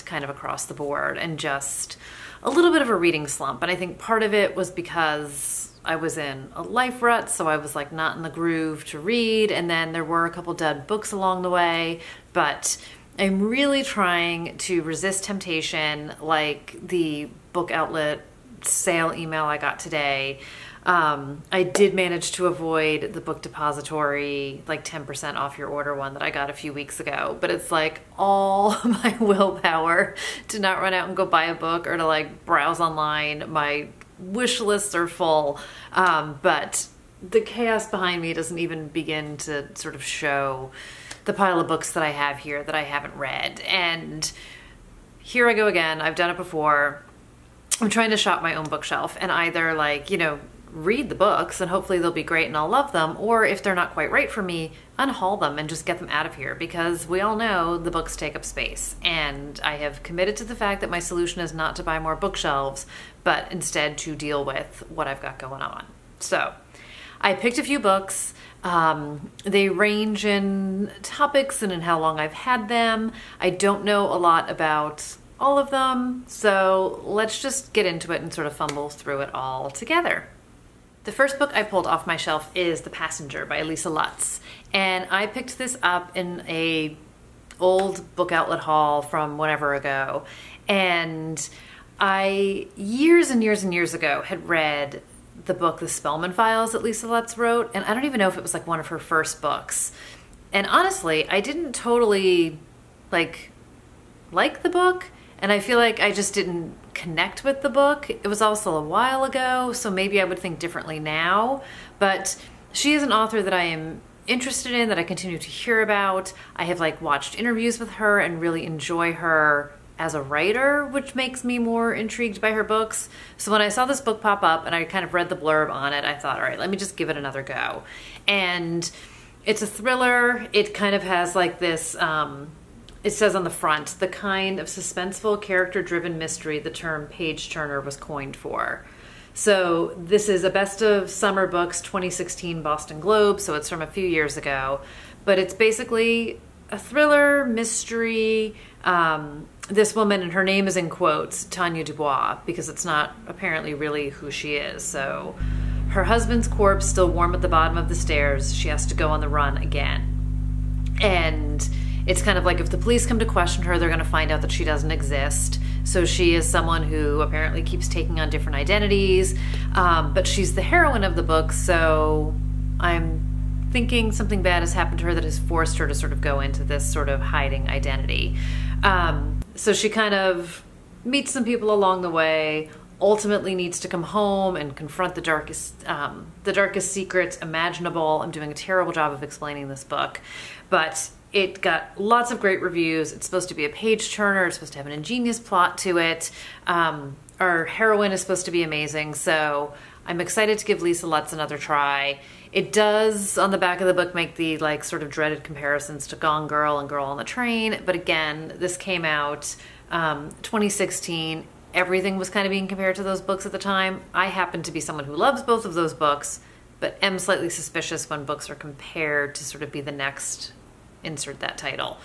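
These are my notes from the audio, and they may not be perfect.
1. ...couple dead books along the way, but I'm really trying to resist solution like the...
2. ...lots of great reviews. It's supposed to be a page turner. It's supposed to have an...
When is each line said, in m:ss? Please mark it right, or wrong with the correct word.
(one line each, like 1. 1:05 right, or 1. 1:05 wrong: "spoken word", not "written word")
1. 0:10 wrong: "temptation", not "solution"
2. 3:11 right.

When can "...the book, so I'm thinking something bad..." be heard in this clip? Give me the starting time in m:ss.
2:51.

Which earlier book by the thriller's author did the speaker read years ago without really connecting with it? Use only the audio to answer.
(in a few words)
The Spellman Files.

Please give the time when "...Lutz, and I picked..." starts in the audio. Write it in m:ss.
1:23.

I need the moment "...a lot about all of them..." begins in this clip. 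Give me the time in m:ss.
1:14.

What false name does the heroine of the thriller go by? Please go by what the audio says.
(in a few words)
Tanya Dubois.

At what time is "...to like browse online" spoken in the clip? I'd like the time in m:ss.
0:31.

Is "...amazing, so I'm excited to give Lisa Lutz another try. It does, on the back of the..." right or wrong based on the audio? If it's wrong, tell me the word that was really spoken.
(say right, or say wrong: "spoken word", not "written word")
right.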